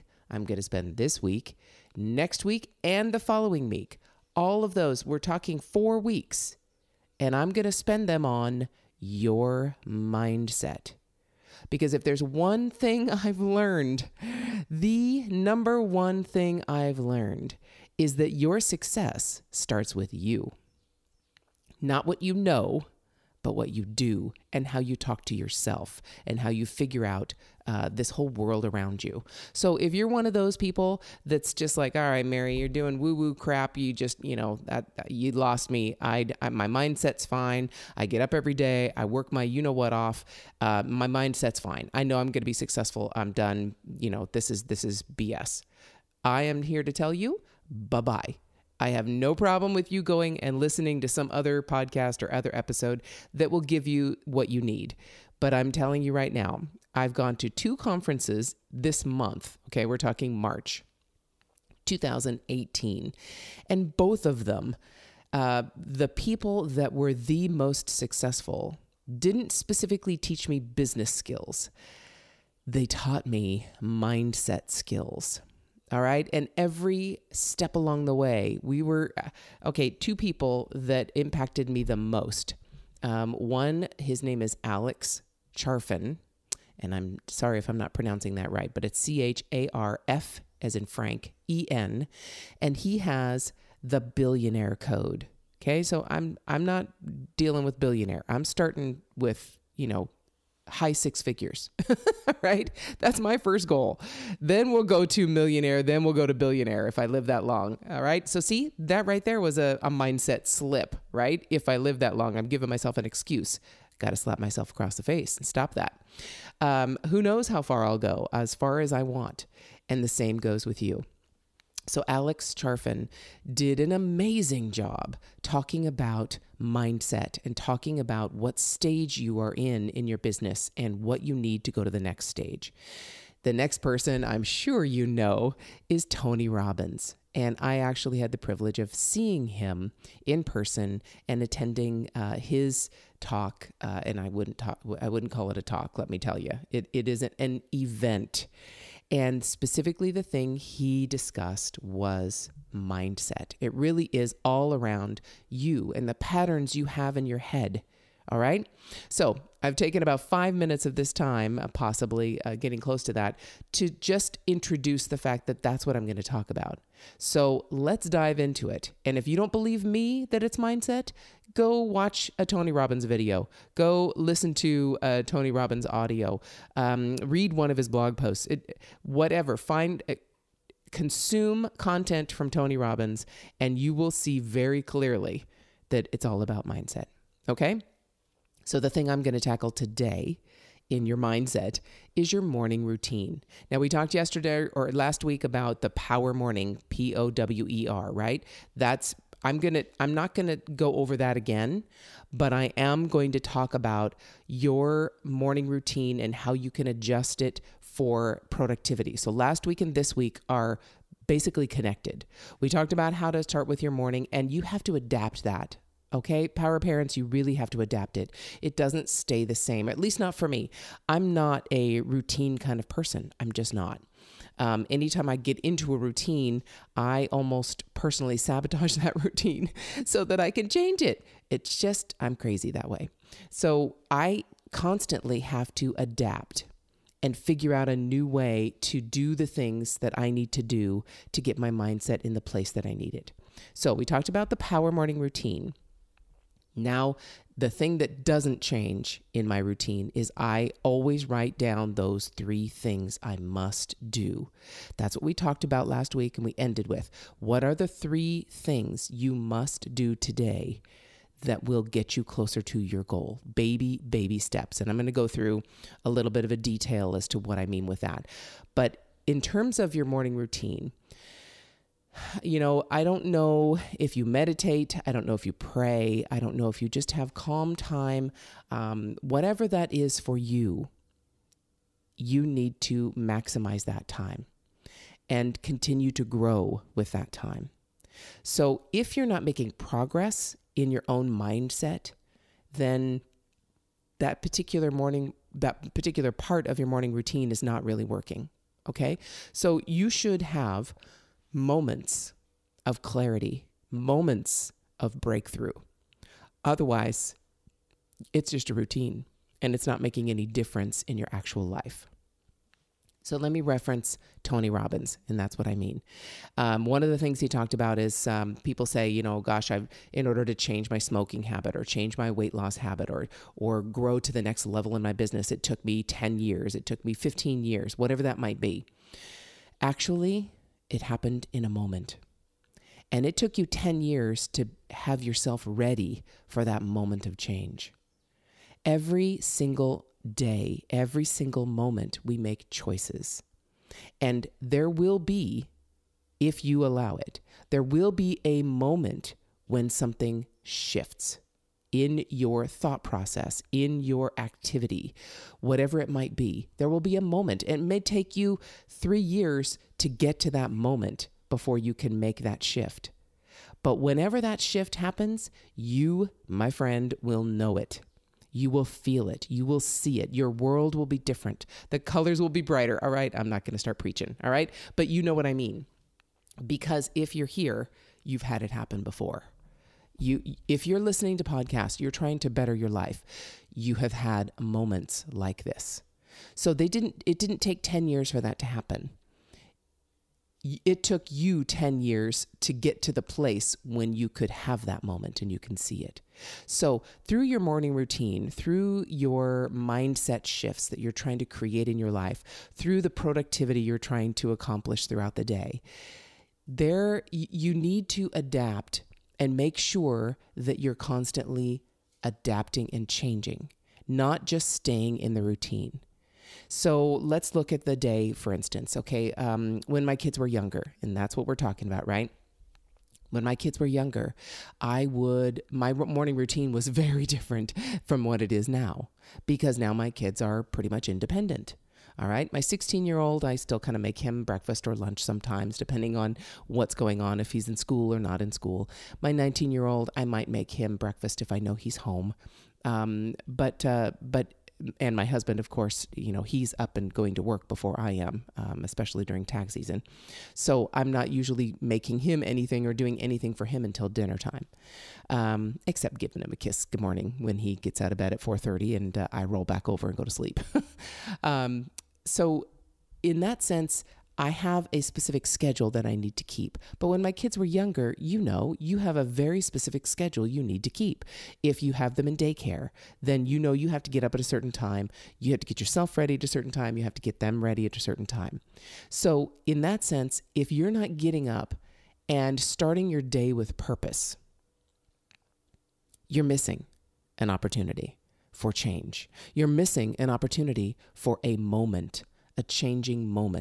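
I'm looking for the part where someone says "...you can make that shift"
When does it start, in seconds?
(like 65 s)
361 s.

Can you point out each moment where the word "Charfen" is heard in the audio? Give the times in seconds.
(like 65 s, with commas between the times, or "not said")
85 s, 122 s.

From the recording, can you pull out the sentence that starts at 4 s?
All of those, we're talking 4 weeks and I'm going to spend them on your mindset.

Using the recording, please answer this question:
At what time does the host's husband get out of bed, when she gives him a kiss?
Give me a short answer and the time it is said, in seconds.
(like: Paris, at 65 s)
4:30, at 458 s.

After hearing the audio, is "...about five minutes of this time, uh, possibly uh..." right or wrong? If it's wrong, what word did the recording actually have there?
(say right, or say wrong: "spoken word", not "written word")
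right.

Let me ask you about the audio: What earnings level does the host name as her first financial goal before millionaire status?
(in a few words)
high six figures.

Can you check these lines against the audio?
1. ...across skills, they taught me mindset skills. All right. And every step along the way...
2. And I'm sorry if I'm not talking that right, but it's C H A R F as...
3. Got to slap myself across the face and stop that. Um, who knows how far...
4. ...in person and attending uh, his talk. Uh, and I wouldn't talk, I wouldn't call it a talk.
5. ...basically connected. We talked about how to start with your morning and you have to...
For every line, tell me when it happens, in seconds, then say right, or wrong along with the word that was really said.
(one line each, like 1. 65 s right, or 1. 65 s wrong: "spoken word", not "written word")
1. 70 s wrong: "business", not "across"
2. 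86 s wrong: "pronouncing", not "talking"
3. 113 s right
4. 140 s right
5. 211 s right.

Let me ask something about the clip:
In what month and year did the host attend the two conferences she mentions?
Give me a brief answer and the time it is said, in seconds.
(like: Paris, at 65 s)
March 2018, at 60 s.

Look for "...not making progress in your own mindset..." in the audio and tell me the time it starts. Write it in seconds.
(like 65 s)
289 s.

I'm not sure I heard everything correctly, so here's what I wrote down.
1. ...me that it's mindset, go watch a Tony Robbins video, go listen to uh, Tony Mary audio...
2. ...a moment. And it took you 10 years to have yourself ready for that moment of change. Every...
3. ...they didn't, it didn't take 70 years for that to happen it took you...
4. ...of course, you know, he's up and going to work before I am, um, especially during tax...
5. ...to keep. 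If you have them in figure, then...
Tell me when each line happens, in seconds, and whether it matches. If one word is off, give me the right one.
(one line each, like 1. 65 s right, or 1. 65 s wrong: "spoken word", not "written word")
1. 169 s wrong: "Robbins", not "Mary"
2. 331 s right
3. 386 s wrong: "10", not "70"
4. 445 s right
5. 470 s wrong: "daycare", not "figure".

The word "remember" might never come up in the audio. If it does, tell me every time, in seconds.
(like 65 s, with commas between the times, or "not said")
not said.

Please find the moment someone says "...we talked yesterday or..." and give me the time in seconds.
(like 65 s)
193 s.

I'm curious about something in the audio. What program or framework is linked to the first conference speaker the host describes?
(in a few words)
the billionaire code.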